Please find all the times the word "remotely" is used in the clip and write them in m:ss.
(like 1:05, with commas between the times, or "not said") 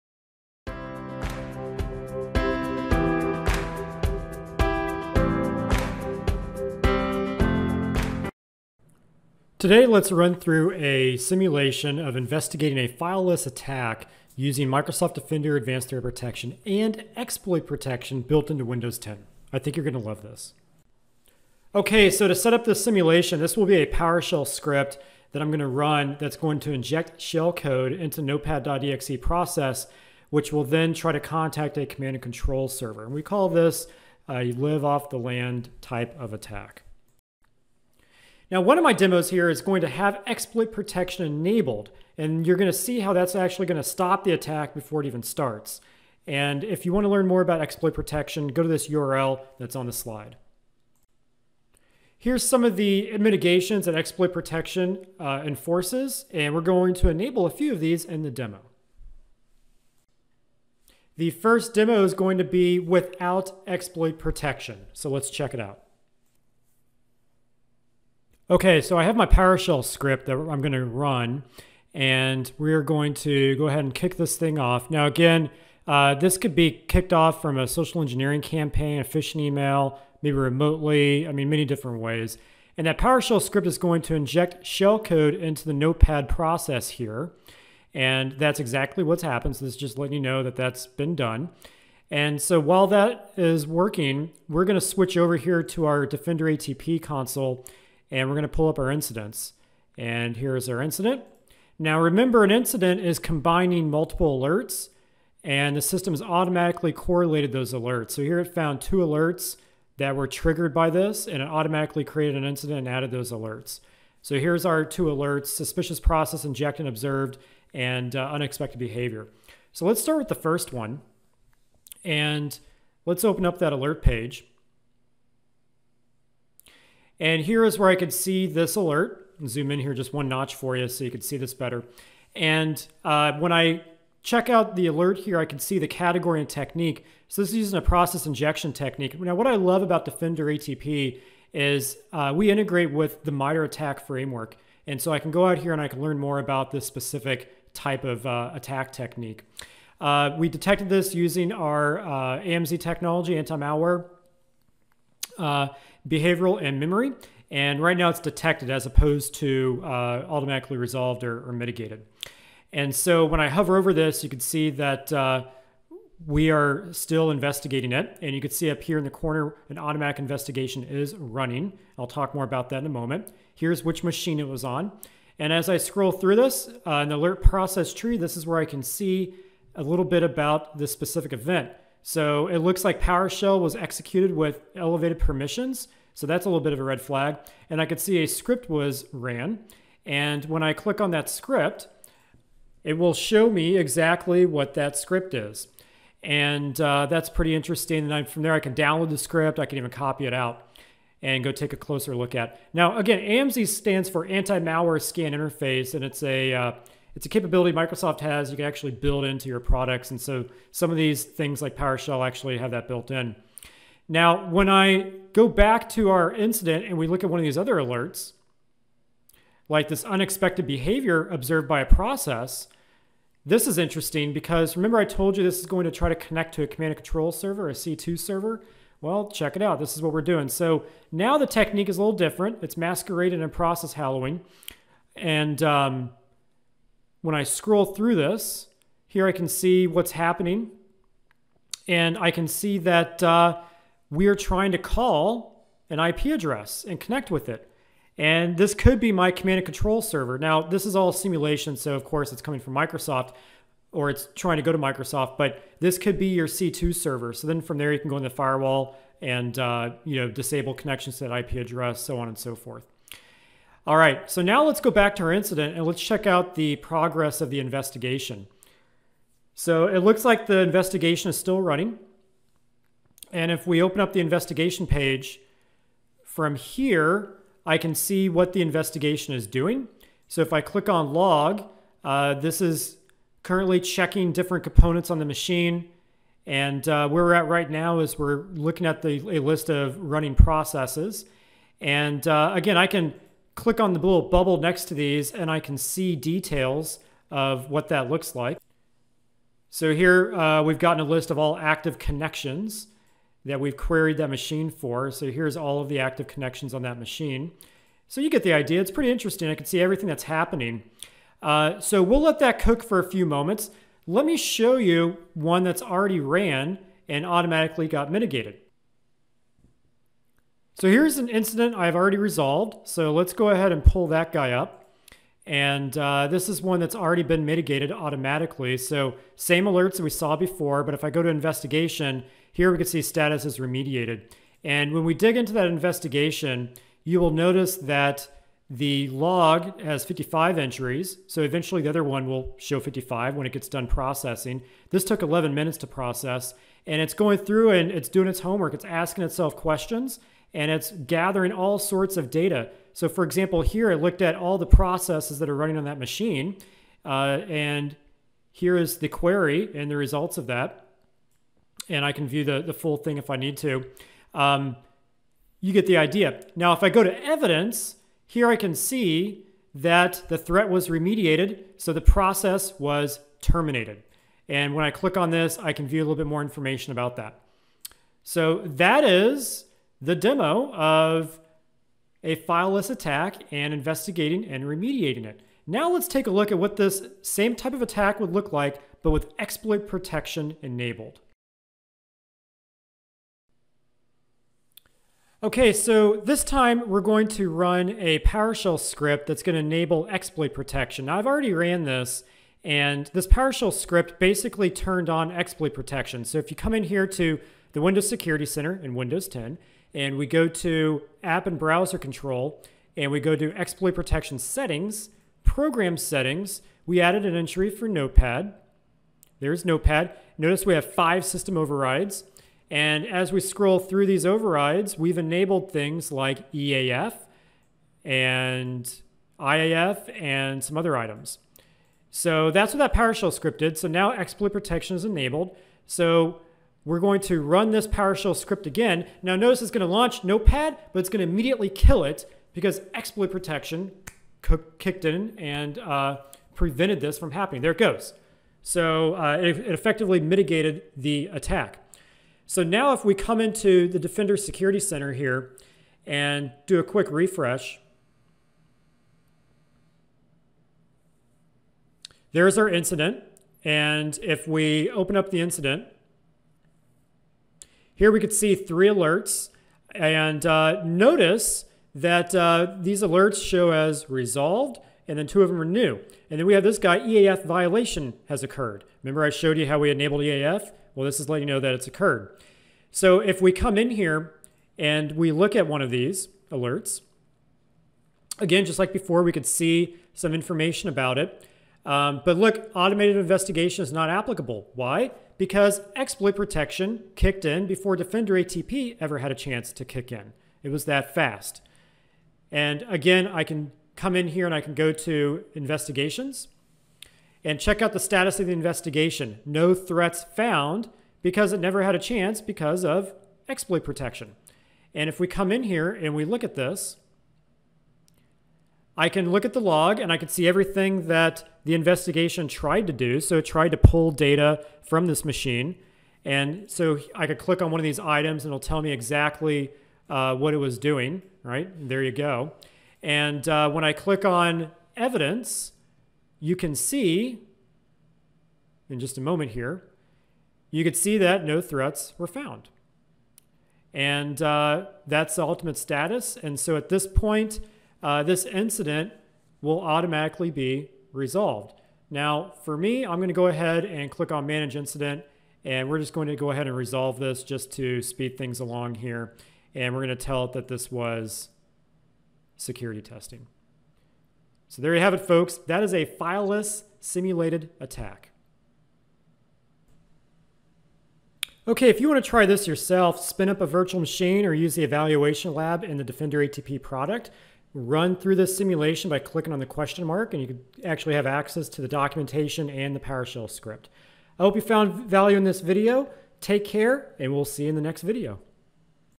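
1:20.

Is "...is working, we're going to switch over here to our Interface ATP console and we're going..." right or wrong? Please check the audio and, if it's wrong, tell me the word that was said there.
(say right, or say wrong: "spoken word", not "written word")
wrong: "Defender", not "Interface".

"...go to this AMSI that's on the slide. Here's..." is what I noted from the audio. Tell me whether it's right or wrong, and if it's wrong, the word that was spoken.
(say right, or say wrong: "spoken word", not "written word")
wrong: "URL", not "AMSI".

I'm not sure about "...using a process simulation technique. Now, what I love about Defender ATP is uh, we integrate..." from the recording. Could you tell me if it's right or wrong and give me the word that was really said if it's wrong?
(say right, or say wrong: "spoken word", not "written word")
wrong: "injection", not "simulation".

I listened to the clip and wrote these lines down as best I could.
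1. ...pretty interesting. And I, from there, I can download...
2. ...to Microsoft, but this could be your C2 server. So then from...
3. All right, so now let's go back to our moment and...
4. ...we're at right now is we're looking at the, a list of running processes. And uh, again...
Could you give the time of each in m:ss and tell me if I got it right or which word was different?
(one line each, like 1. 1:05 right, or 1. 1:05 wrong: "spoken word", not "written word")
1. 3:17 right
2. 4:14 right
3. 4:23 wrong: "incident", not "moment"
4. 4:47 right.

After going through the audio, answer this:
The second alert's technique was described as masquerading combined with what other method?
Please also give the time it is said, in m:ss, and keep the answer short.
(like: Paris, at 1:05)
Process hollowing, at 3:53.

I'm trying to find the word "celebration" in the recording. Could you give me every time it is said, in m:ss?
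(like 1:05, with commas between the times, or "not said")
not said.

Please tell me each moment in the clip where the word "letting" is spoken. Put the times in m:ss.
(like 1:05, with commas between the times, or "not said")
1:29, 8:01.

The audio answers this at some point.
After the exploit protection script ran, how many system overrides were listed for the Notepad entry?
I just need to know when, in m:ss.
7:00.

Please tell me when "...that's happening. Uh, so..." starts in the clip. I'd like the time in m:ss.
5:10.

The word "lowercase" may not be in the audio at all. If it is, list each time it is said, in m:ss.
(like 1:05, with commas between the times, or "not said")
not said.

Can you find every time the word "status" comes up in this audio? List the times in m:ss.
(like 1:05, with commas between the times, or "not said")
5:33, 8:27, 9:05.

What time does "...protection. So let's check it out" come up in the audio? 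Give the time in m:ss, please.
1:04.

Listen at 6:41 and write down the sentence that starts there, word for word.
Now I've already ran this, and this PowerShell script basically turned on exploit protection.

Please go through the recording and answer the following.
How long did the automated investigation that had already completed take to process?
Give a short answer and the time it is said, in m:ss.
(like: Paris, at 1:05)
11 minutes, at 5:45.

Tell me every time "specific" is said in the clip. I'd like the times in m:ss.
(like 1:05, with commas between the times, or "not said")
2:26, 3:00.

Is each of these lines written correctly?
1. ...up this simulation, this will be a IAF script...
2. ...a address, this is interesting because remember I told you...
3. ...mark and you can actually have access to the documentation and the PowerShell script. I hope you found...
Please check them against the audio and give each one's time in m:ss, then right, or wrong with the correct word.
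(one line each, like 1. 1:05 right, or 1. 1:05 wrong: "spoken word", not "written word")
1. 0:22 wrong: "PowerShell", not "IAF"
2. 3:41 wrong: "process", not "address"
3. 9:40 right.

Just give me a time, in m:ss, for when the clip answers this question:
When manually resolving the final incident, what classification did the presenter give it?
9:22.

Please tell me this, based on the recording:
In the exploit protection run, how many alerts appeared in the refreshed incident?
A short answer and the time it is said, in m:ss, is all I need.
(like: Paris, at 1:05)
3, at 7:48.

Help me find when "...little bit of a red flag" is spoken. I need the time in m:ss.
3:06.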